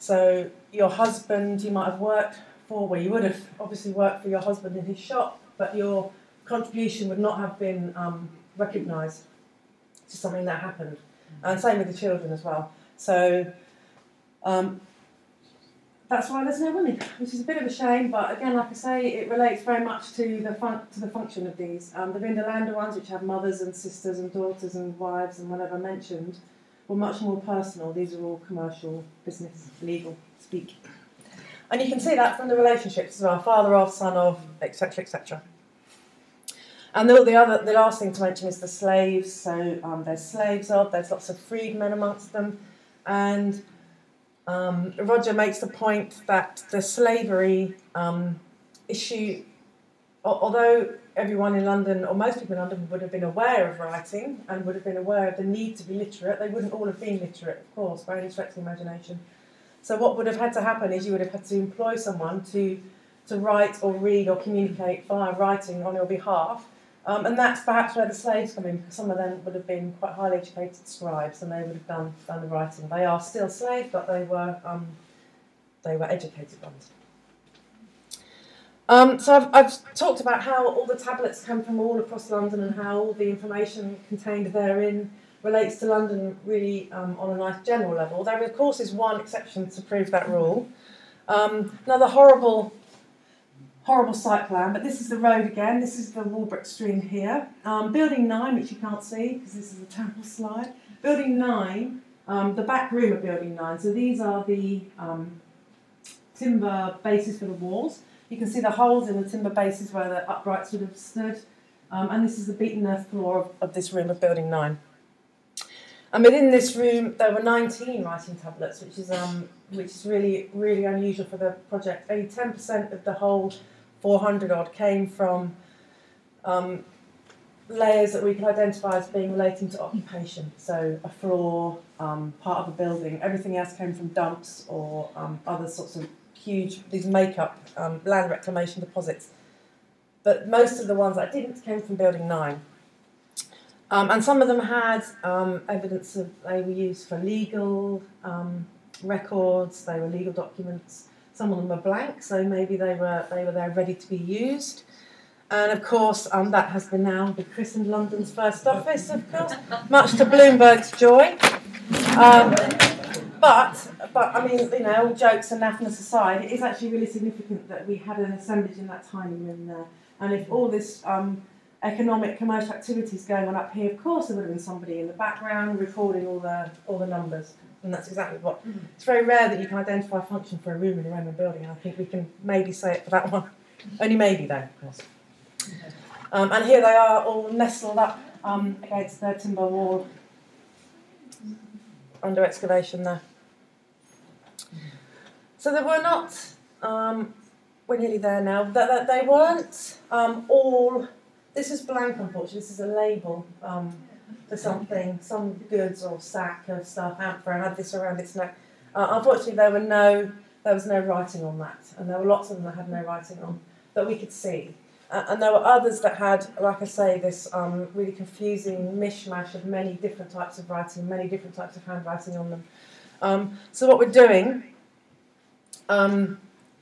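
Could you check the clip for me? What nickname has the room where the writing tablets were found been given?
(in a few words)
London's first office.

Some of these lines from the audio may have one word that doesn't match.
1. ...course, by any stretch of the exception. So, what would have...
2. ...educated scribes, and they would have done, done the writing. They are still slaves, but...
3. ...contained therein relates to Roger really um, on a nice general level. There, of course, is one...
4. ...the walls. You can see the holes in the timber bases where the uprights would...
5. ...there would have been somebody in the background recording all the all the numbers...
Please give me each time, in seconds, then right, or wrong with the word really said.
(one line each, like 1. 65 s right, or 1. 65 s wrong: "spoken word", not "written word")
1. 57 s wrong: "imagination", not "exception"
2. 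70 s right
3. 84 s wrong: "London", not "Roger"
4. 107 s right
5. 174 s right.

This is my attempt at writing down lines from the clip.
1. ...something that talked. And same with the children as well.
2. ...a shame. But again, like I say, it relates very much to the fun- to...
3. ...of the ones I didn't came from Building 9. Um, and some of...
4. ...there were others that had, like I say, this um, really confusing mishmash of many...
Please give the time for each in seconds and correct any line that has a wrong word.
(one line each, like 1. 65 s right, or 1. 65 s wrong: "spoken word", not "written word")
1. 10 s wrong: "happened", not "talked"
2. 17 s right
3. 140 s right
4. 215 s right.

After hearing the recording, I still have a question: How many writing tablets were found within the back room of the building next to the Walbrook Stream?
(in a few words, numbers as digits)
19.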